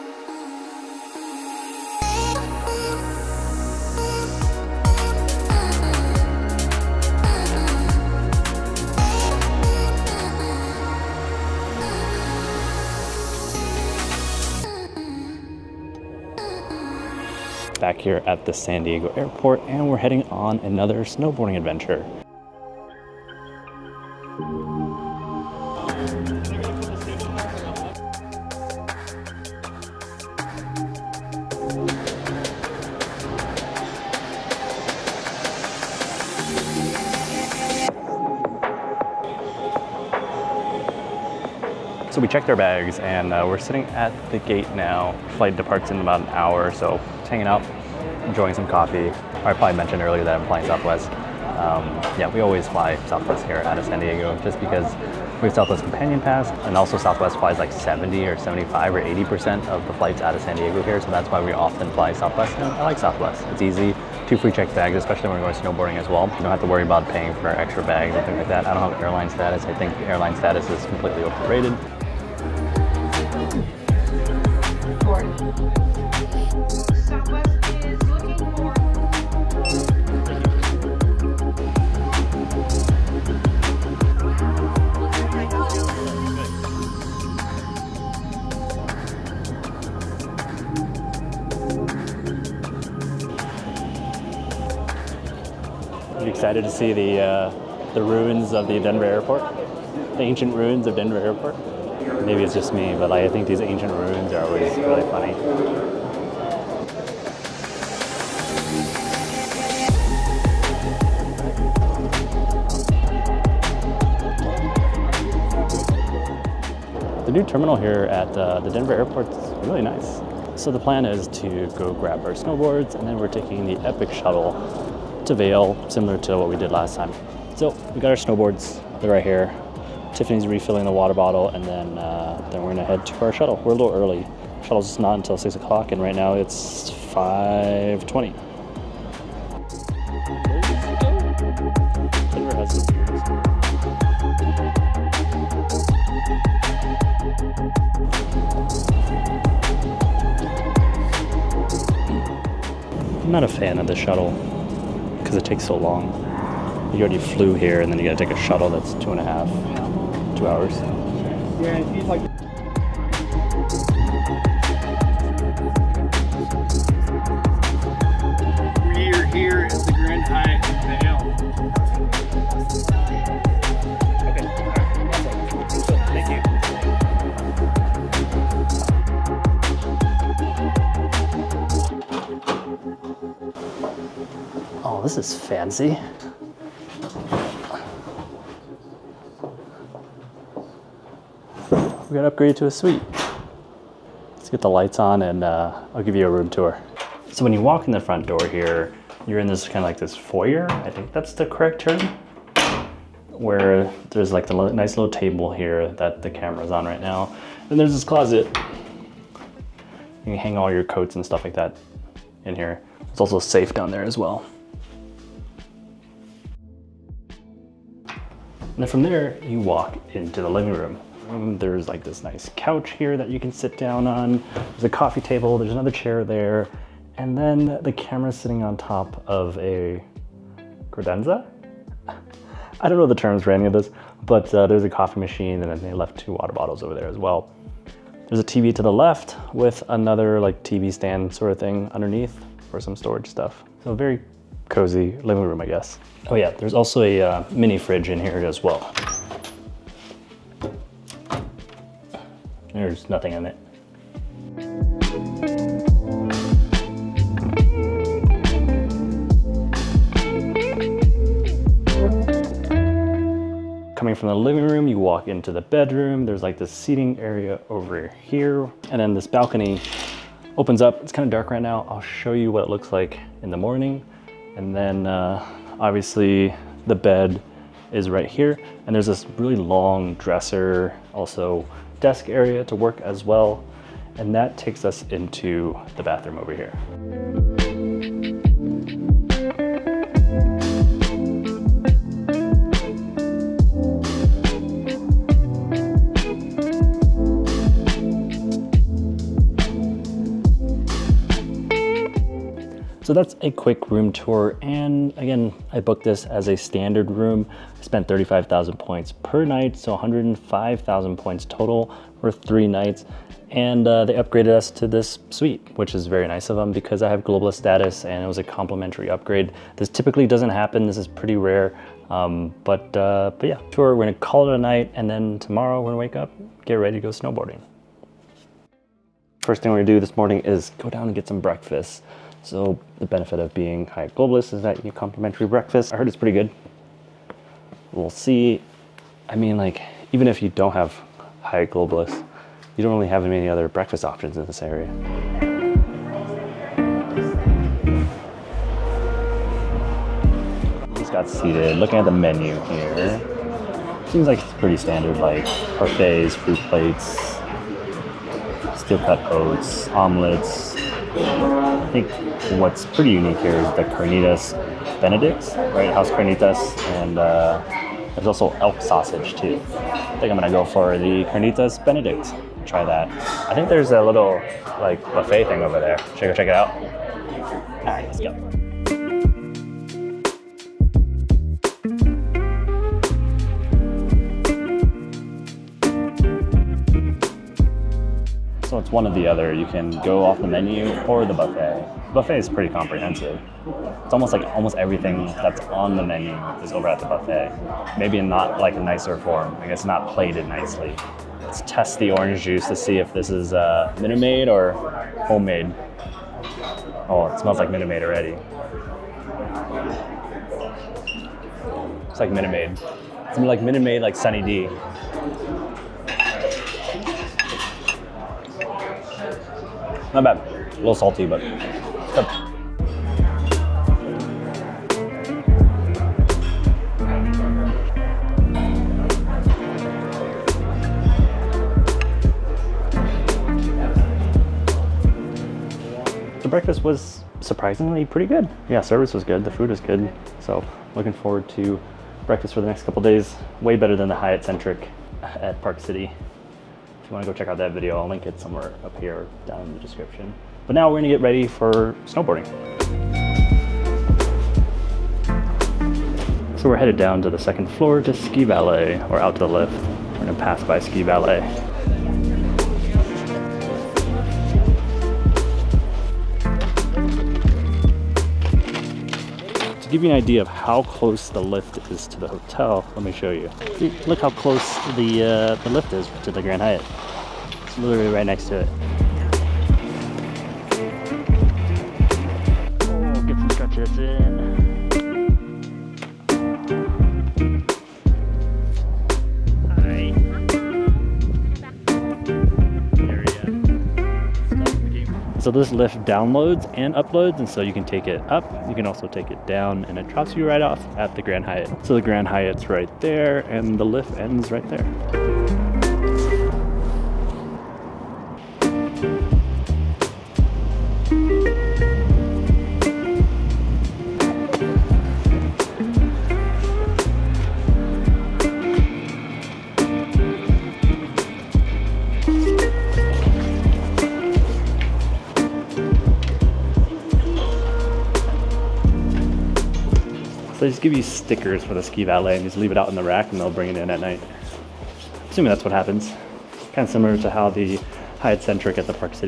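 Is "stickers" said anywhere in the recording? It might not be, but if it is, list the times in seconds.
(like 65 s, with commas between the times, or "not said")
531 s.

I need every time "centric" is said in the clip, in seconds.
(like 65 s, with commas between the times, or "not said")
444 s, 538 s.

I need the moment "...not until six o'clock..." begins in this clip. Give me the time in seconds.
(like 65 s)
134 s.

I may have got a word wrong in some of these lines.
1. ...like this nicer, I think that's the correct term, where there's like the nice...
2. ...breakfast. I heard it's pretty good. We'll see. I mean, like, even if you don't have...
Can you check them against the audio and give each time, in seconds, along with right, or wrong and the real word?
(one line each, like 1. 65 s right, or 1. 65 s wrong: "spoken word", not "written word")
1. 199 s wrong: "foyer", not "nicer"
2. 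335 s right.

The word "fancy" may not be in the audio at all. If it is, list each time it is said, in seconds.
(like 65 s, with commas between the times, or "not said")
185 s.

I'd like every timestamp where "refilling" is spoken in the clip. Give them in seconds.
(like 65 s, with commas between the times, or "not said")
130 s.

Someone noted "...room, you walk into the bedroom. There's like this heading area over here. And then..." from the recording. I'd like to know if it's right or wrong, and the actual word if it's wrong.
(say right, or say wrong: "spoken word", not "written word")
wrong: "seating", not "heading".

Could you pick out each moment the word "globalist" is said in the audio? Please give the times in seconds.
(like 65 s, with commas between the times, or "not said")
317 s, 334 s, 341 s.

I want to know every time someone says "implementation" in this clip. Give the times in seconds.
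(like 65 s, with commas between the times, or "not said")
not said.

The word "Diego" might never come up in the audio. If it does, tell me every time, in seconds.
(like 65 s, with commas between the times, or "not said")
18 s, 53 s, 60 s.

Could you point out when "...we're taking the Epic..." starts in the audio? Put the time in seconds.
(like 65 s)
123 s.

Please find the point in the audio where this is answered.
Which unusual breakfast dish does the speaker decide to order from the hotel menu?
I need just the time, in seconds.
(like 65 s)
371 s.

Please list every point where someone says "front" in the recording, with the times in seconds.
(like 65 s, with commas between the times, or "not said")
197 s.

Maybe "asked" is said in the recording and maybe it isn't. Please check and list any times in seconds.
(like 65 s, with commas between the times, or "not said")
not said.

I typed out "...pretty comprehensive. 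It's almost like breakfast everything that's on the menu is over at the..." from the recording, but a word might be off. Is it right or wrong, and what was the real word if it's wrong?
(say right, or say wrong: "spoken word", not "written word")
wrong: "almost", not "breakfast".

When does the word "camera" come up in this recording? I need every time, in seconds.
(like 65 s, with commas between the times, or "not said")
206 s, 227 s.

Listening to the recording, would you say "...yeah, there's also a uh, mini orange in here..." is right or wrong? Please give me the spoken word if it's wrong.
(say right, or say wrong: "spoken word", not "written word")
wrong: "fridge", not "orange".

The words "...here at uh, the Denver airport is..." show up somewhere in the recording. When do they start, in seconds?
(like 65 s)
117 s.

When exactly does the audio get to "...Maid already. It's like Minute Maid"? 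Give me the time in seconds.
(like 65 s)
407 s.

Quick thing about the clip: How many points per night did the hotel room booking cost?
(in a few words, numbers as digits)
35,000.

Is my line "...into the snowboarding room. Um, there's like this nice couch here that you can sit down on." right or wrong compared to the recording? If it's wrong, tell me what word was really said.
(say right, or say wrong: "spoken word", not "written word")
wrong: "living", not "snowboarding".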